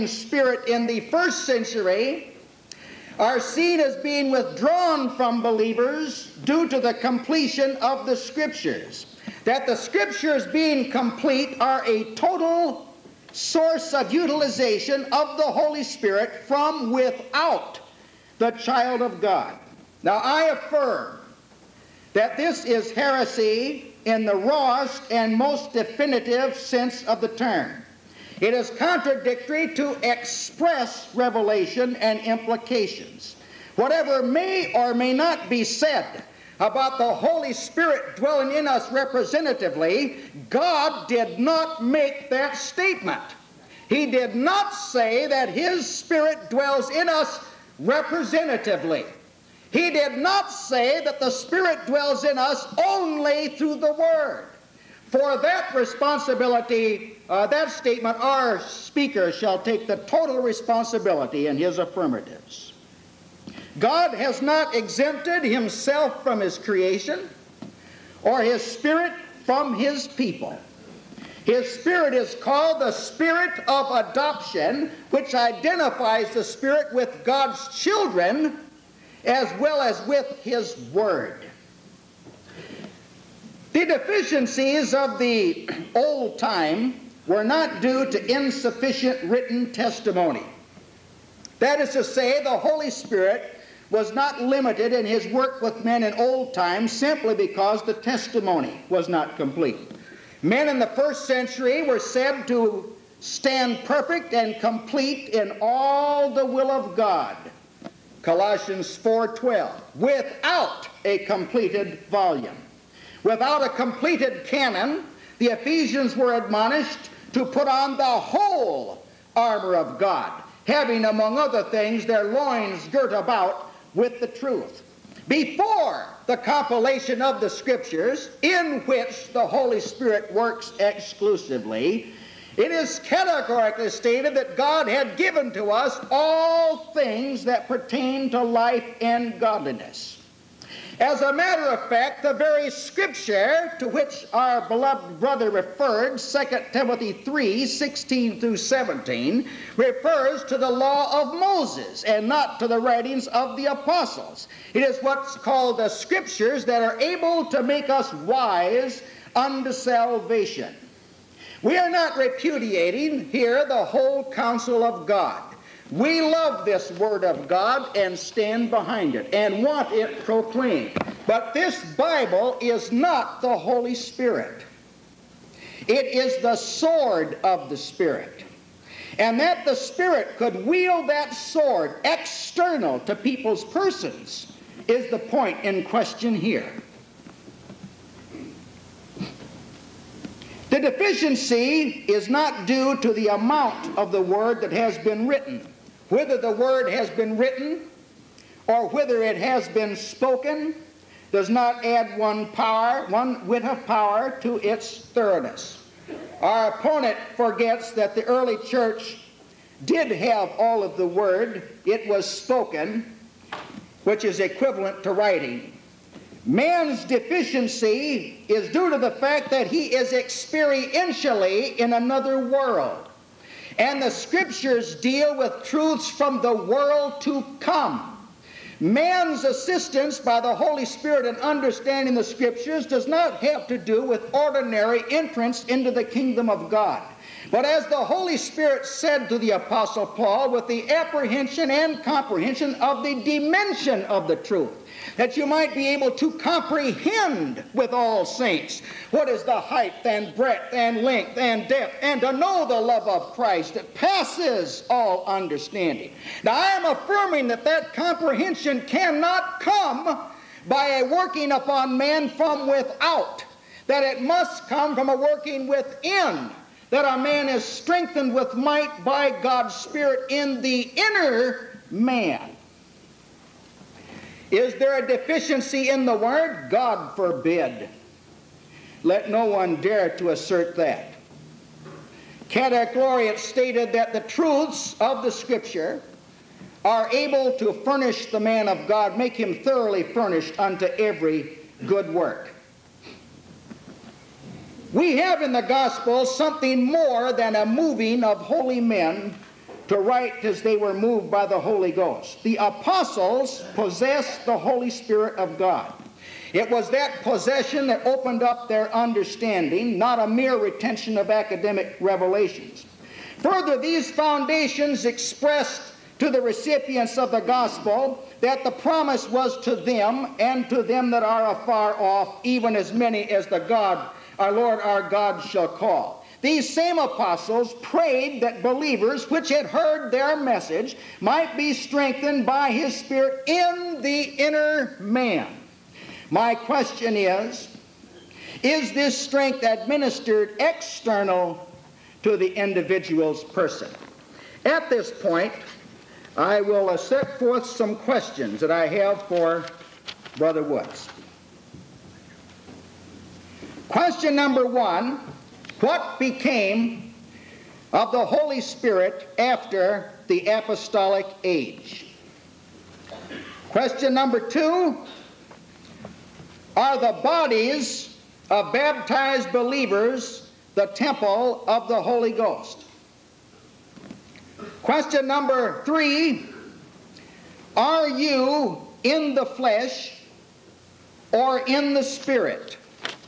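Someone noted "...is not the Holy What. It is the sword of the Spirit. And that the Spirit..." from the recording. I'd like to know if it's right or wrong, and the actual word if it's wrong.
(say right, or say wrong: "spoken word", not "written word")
wrong: "Spirit", not "What".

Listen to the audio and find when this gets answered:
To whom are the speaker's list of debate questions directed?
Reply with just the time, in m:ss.
5:50.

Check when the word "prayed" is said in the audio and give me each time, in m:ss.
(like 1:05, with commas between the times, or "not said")
5:27.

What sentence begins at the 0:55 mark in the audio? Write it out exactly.
For that responsibility, uh, that statement, our speaker shall take the total responsibility in his affirmatives.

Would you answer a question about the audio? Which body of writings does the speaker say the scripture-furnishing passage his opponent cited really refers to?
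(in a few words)
The law of Moses.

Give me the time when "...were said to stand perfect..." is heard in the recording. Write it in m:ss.
1:41.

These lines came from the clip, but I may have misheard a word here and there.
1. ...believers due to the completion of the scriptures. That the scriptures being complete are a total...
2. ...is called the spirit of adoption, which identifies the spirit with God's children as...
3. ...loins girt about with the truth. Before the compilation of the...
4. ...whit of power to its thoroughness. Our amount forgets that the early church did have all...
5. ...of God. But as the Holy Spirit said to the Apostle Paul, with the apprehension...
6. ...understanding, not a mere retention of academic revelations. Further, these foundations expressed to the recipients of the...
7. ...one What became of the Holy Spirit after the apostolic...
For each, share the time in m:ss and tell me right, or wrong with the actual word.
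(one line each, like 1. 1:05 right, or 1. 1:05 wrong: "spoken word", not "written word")
1. 0:05 right
2. 1:12 right
3. 2:02 right
4. 3:23 wrong: "opponent", not "amount"
5. 3:56 right
6. 5:08 right
7. 5:54 right.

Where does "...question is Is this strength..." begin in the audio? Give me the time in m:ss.
5:36.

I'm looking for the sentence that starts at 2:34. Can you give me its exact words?
It is what's called the scriptures that are able to make us wise unto salvation.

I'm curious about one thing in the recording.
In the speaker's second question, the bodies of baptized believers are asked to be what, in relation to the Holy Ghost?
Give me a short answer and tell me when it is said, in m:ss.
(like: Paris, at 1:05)
The temple, at 6:10.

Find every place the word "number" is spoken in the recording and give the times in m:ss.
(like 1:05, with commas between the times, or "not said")
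5:54, 6:04, 6:15.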